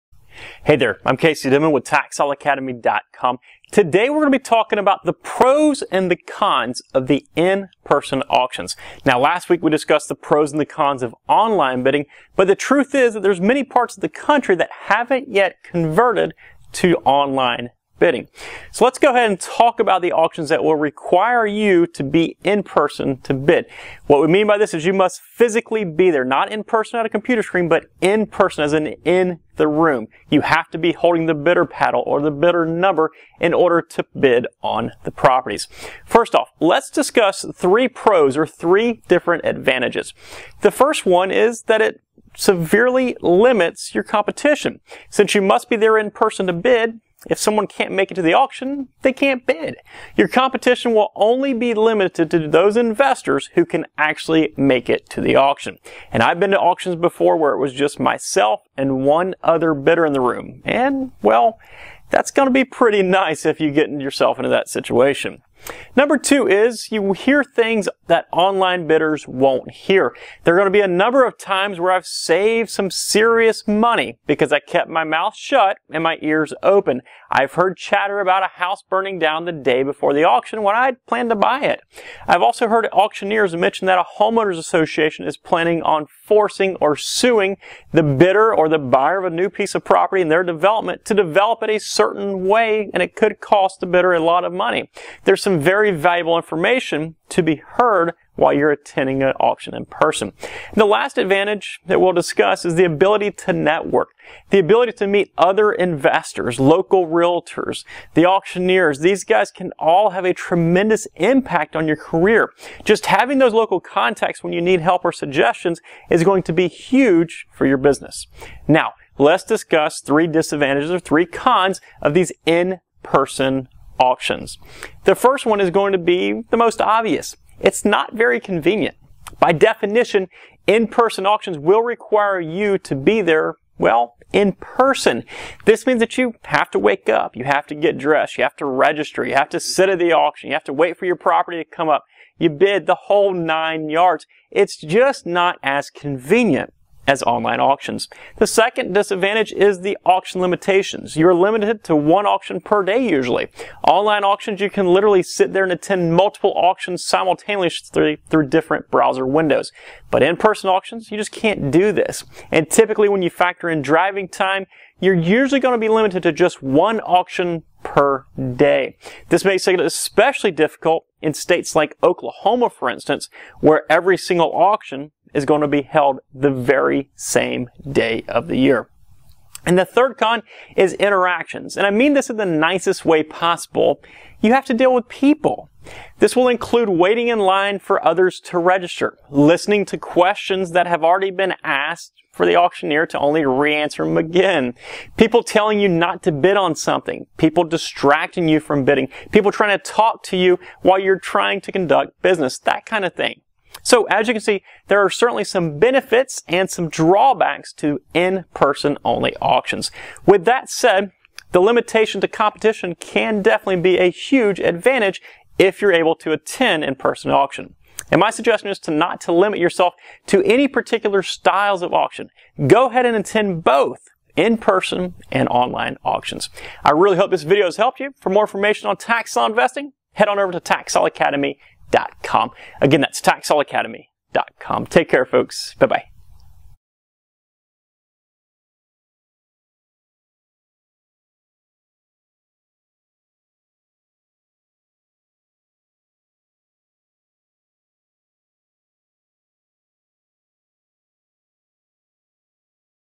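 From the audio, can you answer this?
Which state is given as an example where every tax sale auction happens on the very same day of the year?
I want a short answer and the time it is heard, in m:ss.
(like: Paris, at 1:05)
Oklahoma, at 2:52.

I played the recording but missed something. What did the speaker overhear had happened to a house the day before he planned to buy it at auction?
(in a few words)
burning down.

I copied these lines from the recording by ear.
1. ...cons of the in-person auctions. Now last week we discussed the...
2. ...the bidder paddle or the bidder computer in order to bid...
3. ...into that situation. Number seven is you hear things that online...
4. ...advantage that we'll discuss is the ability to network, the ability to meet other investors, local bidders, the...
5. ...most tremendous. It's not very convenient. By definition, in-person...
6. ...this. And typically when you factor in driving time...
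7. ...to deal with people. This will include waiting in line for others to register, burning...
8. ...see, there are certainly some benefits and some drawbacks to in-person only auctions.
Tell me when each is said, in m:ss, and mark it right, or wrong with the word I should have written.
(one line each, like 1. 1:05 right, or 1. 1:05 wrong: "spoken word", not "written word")
1. 0:06 right
2. 0:31 wrong: "number", not "computer"
3. 1:04 wrong: "two", not "seven"
4. 1:41 wrong: "realtors", not "bidders"
5. 2:06 wrong: "obvious", not "tremendous"
6. 2:41 right
7. 3:04 wrong: "listening", not "burning"
8. 3:24 right.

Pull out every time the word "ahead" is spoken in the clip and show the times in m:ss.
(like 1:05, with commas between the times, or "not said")
0:19, 3:42.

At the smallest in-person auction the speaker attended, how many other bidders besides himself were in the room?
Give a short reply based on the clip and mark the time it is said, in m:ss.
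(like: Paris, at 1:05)
1, at 0:59.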